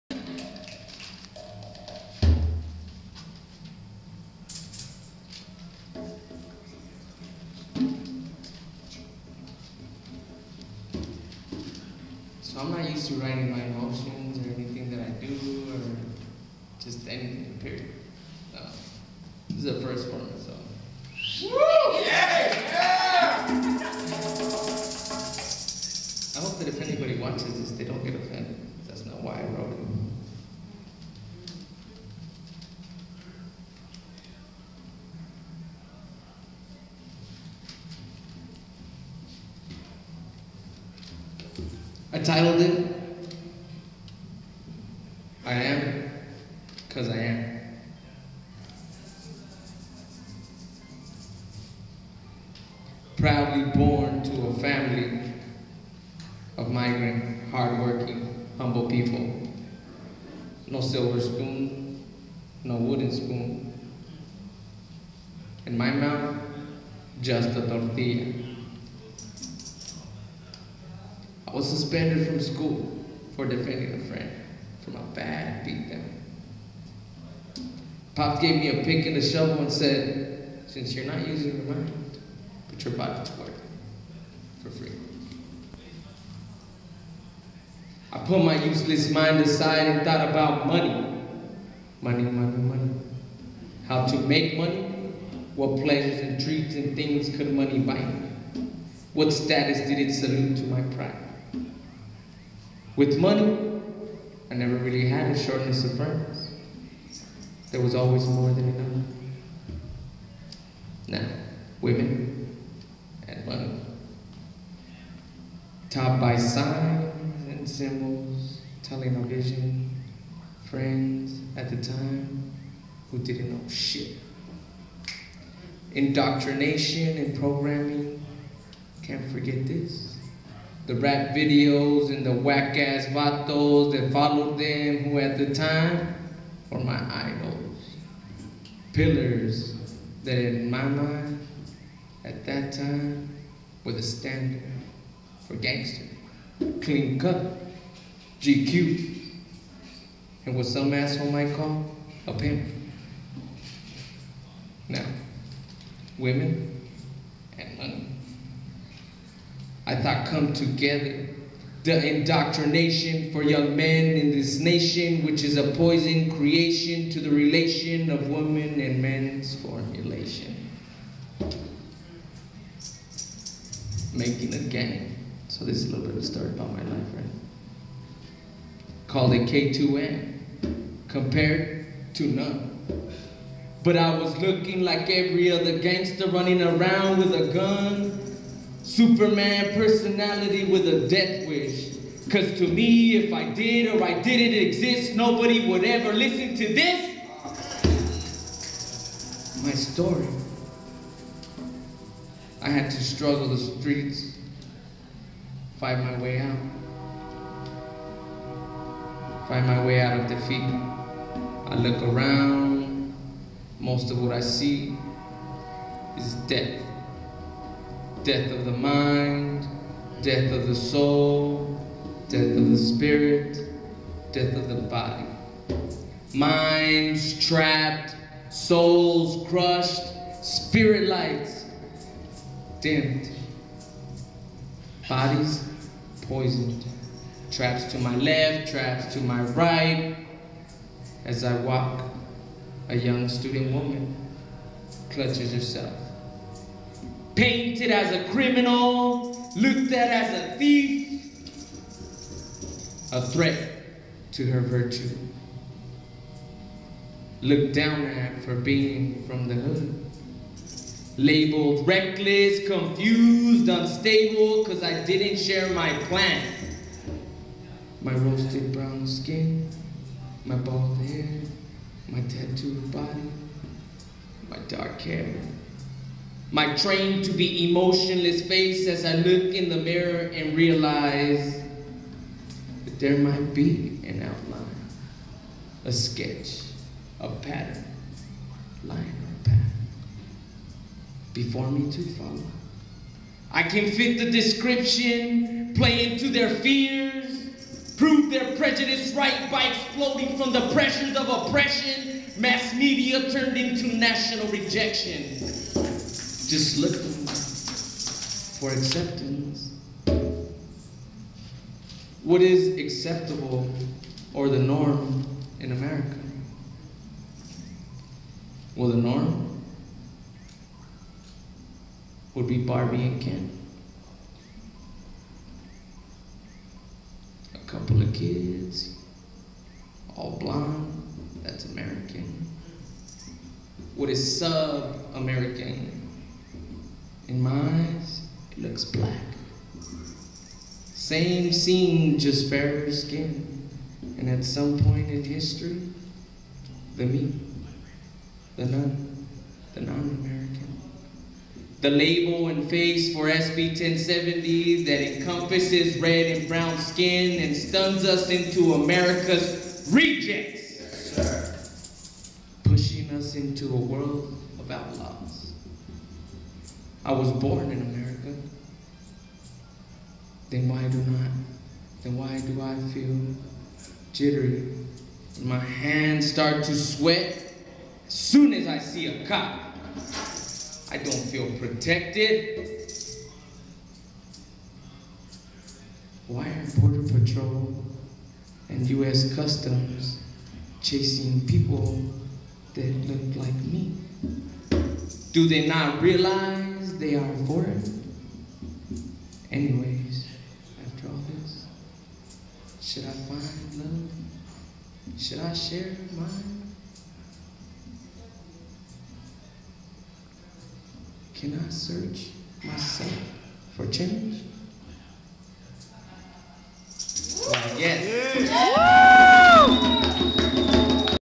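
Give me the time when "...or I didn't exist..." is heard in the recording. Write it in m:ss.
3:13.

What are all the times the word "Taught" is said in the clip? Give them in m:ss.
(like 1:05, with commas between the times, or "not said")
1:55.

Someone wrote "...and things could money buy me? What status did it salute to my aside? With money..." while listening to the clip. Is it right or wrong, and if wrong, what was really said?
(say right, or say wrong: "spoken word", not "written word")
wrong: "pride", not "aside".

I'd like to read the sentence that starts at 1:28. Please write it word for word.
I put my useless mind aside and thought about money.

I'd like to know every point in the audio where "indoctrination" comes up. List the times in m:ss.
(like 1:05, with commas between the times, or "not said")
2:05, 2:42.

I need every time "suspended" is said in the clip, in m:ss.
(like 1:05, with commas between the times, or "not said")
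1:11.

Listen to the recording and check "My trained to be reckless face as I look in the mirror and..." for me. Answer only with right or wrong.
wrong.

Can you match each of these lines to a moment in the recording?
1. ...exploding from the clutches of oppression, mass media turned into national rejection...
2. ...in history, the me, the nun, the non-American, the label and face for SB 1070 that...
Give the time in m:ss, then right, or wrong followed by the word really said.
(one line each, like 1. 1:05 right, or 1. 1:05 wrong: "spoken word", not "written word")
1. 4:59 wrong: "pressures", not "clutches"
2. 5:45 right.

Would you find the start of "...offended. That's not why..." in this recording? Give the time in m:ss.
0:28.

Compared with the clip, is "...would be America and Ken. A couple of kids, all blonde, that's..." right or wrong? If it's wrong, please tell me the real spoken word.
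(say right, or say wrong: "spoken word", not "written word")
wrong: "Barbie", not "America".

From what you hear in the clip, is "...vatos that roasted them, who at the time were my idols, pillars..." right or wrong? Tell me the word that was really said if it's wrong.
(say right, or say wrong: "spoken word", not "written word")
wrong: "followed", not "roasted".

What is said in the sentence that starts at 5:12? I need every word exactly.
What is acceptable or the norm in America?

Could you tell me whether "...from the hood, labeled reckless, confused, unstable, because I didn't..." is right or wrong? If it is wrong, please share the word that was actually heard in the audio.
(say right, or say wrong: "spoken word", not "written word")
right.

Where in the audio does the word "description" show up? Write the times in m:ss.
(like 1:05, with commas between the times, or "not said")
4:54.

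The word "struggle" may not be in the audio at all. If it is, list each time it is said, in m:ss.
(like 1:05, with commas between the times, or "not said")
3:23.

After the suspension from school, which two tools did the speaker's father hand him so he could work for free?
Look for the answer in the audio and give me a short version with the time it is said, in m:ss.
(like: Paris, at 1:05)
A pick and a shovel, at 1:18.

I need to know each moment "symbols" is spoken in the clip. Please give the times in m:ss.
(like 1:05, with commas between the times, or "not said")
1:57.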